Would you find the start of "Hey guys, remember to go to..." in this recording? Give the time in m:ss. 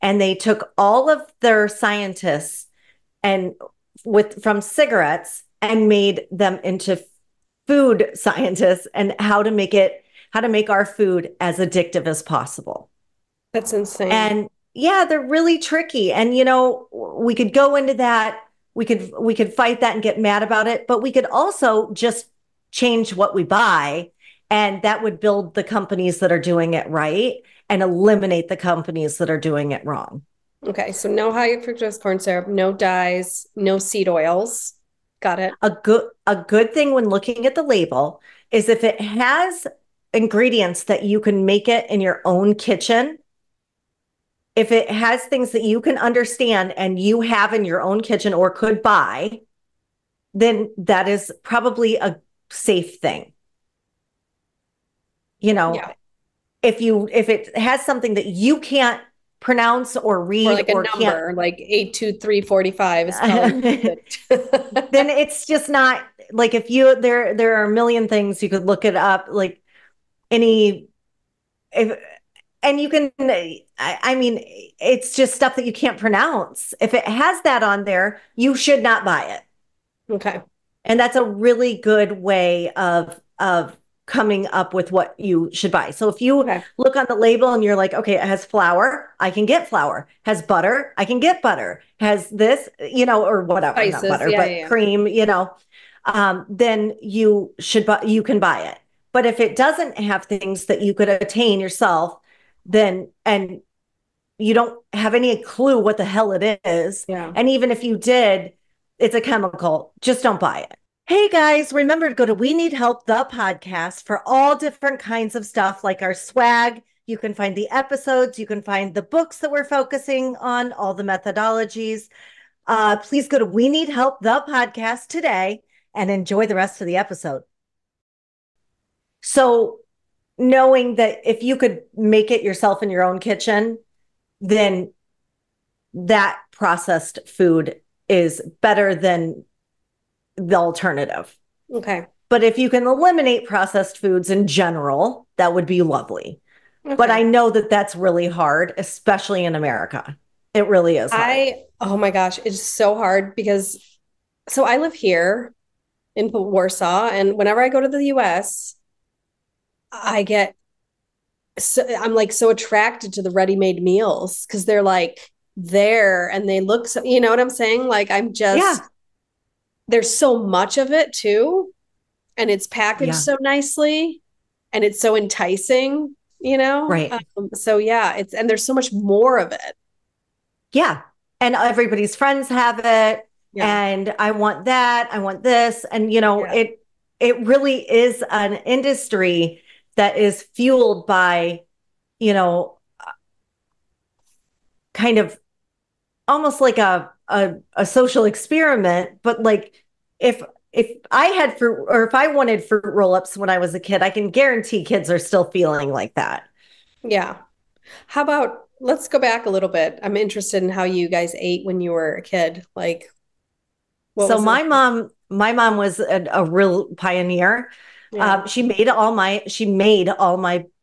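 1:51.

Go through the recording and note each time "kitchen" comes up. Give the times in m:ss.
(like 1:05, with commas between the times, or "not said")
0:42, 0:48, 2:13.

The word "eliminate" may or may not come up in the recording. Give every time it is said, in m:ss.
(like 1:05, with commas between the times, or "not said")
0:27, 2:22.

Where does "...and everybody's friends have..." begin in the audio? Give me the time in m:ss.
3:01.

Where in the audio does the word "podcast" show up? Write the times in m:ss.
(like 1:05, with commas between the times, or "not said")
1:53, 2:04.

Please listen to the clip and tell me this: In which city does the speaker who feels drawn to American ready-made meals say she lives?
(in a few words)
Warsaw.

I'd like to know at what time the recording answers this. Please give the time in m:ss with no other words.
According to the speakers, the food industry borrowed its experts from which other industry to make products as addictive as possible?
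0:04.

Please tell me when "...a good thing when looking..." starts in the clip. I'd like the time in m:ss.
0:36.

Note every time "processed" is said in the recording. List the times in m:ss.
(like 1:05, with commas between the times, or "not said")
2:16, 2:23.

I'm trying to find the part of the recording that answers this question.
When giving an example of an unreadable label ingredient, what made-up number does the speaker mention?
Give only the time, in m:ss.
1:01.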